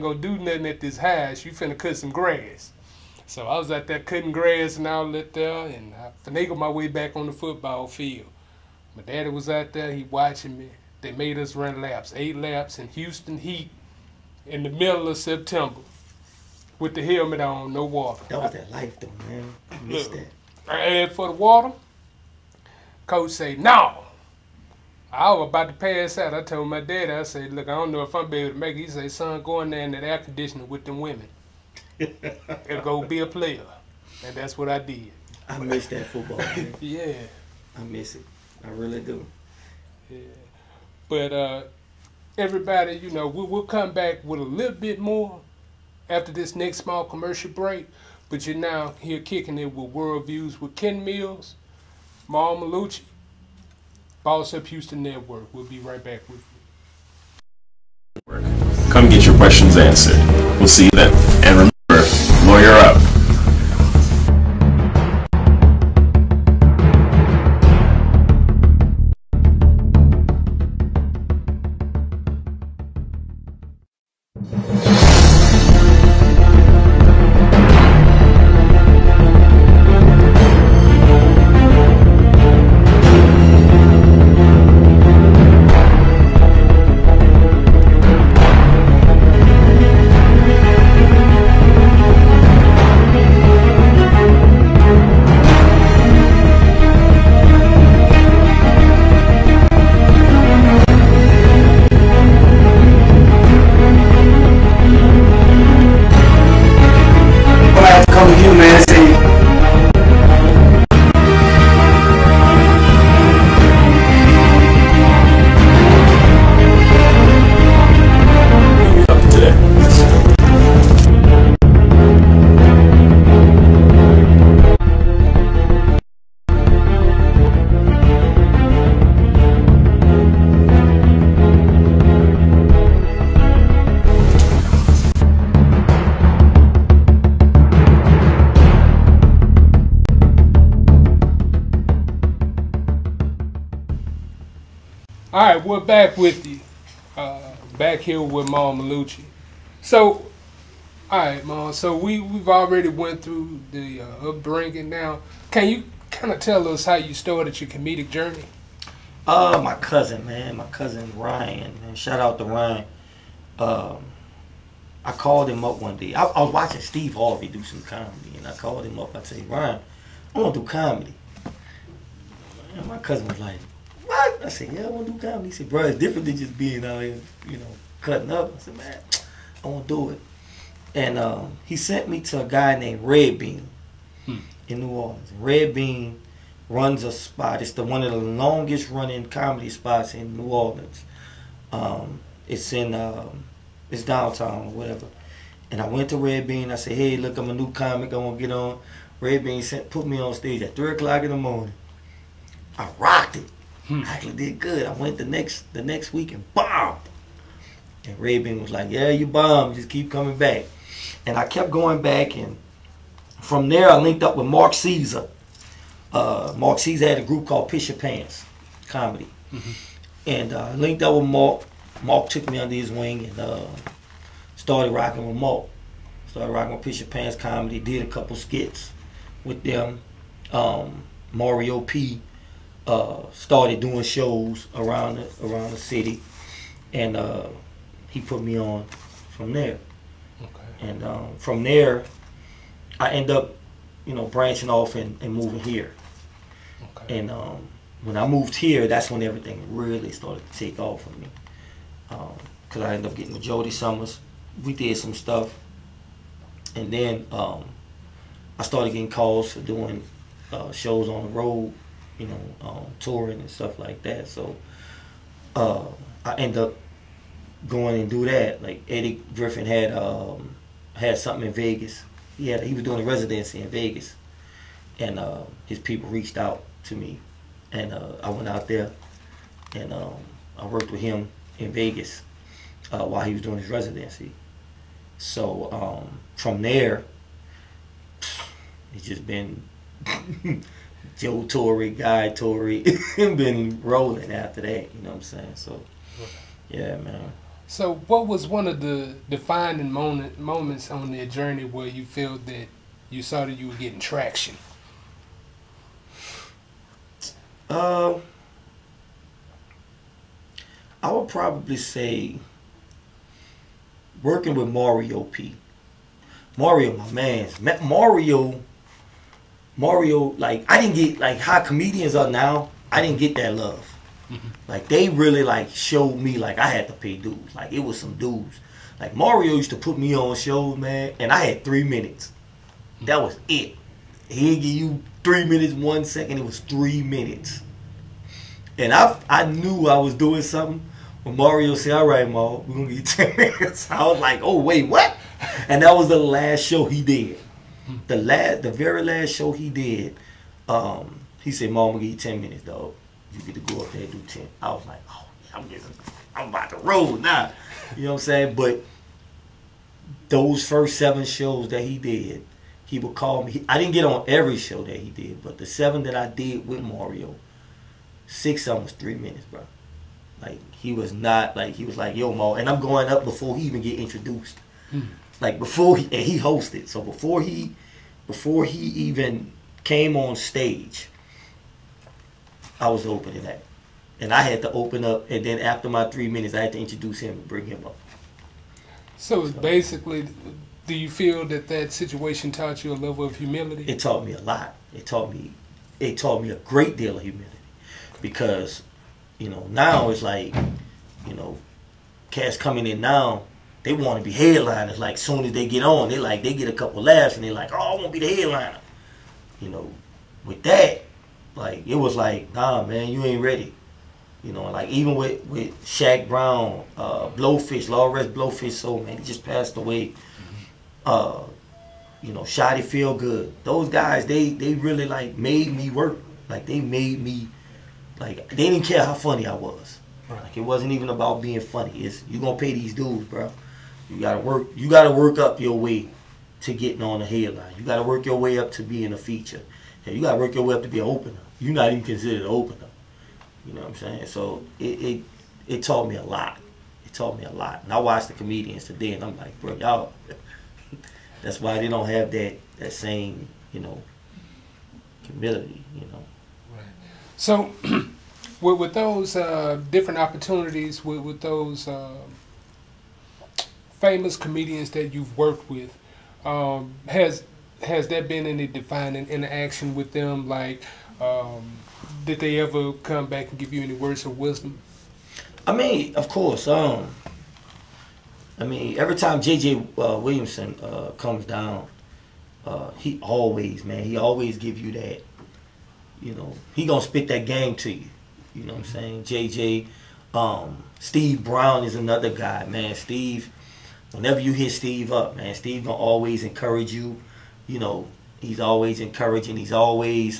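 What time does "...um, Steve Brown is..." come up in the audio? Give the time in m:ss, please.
8:10.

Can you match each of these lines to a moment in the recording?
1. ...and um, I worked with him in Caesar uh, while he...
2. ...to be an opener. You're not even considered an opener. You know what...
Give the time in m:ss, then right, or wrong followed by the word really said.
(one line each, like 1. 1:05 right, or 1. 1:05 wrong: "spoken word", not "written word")
1. 4:39 wrong: "Vegas", not "Caesar"
2. 7:20 right.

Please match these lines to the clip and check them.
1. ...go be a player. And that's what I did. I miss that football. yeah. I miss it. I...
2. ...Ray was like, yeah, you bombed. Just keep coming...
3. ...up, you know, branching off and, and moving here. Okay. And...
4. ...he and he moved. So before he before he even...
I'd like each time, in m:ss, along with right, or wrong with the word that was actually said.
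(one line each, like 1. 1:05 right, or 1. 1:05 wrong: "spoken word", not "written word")
1. 0:32 right
2. 3:28 right
3. 4:03 right
4. 6:15 wrong: "hosted", not "moved".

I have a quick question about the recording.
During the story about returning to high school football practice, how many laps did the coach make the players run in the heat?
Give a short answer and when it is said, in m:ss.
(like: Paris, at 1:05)
8, at 0:12.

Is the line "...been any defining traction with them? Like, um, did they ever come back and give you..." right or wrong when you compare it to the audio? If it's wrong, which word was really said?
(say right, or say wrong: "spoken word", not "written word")
wrong: "interaction", not "traction".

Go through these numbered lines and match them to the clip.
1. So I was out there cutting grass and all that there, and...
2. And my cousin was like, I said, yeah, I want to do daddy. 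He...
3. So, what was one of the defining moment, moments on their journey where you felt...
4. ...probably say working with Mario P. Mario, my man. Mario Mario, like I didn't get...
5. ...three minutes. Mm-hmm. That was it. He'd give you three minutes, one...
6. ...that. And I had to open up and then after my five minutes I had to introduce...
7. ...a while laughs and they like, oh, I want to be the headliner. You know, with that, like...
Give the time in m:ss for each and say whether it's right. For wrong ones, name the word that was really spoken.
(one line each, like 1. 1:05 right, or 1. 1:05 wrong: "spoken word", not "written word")
1. 0:03 right
2. 2:52 wrong: "comedy", not "daddy"
3. 4:57 right
4. 5:11 right
5. 5:31 right
6. 6:23 wrong: "three", not "five"
7. 6:46 wrong: "couple", not "while".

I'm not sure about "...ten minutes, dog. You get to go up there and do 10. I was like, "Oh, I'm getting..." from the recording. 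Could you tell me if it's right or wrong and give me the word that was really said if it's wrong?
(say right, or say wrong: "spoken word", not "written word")
right.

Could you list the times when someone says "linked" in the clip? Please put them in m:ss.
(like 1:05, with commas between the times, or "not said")
3:33, 3:40.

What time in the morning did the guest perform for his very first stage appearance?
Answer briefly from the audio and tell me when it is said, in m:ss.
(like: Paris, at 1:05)
3 o'clock, at 3:20.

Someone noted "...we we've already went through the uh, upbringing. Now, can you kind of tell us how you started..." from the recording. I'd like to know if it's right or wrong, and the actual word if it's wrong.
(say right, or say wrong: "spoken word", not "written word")
right.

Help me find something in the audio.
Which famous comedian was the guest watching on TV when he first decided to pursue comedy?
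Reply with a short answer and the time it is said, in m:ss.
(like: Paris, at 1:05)
Steve Harvey, at 2:46.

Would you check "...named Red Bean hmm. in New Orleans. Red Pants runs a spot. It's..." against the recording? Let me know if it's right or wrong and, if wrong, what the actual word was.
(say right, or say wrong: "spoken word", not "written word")
wrong: "Bean", not "Pants".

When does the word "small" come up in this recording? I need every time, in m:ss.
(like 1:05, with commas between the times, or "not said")
0:46.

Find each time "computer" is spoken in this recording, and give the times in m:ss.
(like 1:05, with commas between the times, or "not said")
not said.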